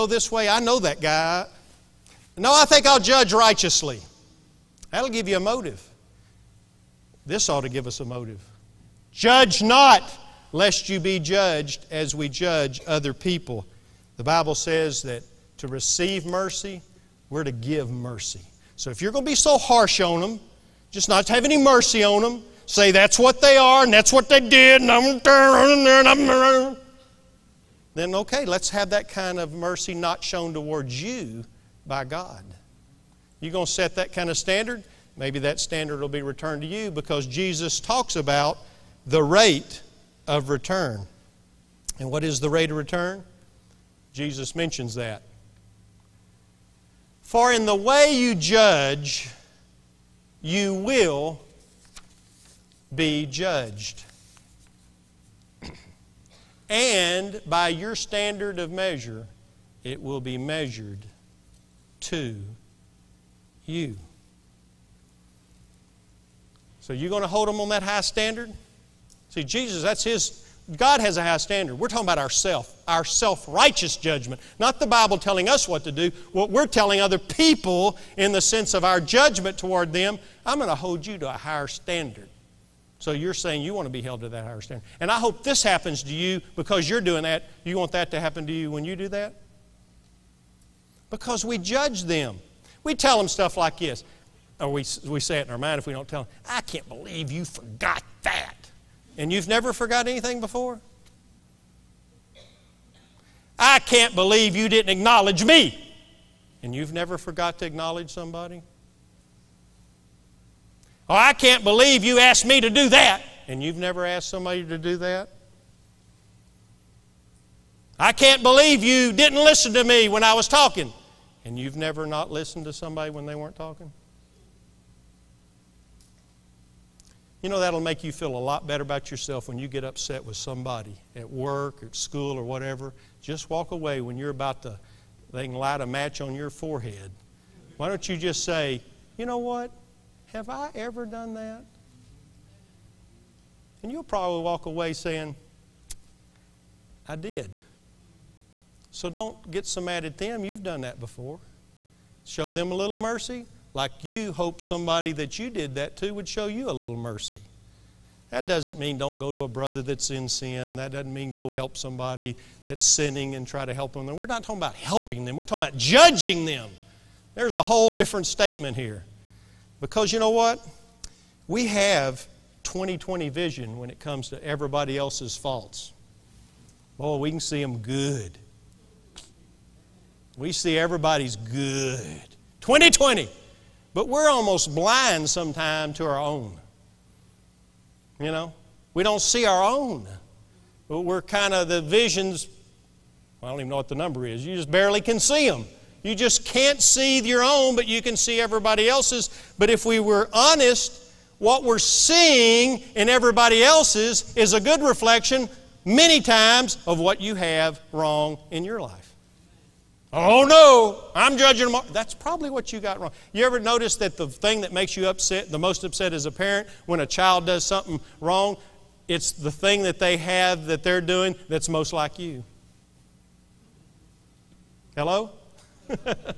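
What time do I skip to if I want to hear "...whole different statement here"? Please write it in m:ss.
2:47.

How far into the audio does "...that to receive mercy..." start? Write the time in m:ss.
0:15.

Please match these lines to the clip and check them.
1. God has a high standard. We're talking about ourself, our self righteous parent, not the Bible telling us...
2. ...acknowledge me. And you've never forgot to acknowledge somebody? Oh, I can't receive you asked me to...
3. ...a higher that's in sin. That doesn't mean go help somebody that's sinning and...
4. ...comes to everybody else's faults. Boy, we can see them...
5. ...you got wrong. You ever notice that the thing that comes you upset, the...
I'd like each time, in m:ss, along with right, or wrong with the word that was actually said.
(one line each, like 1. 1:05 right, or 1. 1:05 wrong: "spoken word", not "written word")
1. 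1:10 wrong: "judgment", not "parent"
2. 1:44 wrong: "believe", not "receive"
3. 2:39 wrong: "brother", not "higher"
4. 2:53 right
5. 3:32 wrong: "makes", not "comes".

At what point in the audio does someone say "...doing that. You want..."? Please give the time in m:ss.
1:26.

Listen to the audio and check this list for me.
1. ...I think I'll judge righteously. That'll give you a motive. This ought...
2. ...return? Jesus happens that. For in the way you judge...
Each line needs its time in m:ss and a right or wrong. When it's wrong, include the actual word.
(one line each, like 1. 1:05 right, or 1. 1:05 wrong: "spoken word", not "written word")
1. 0:02 right
2. 0:42 wrong: "mentions", not "happens".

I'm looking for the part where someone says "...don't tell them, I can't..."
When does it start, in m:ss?
1:35.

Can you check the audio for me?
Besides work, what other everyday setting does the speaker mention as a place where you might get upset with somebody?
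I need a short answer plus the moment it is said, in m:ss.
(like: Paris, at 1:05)
School, at 2:11.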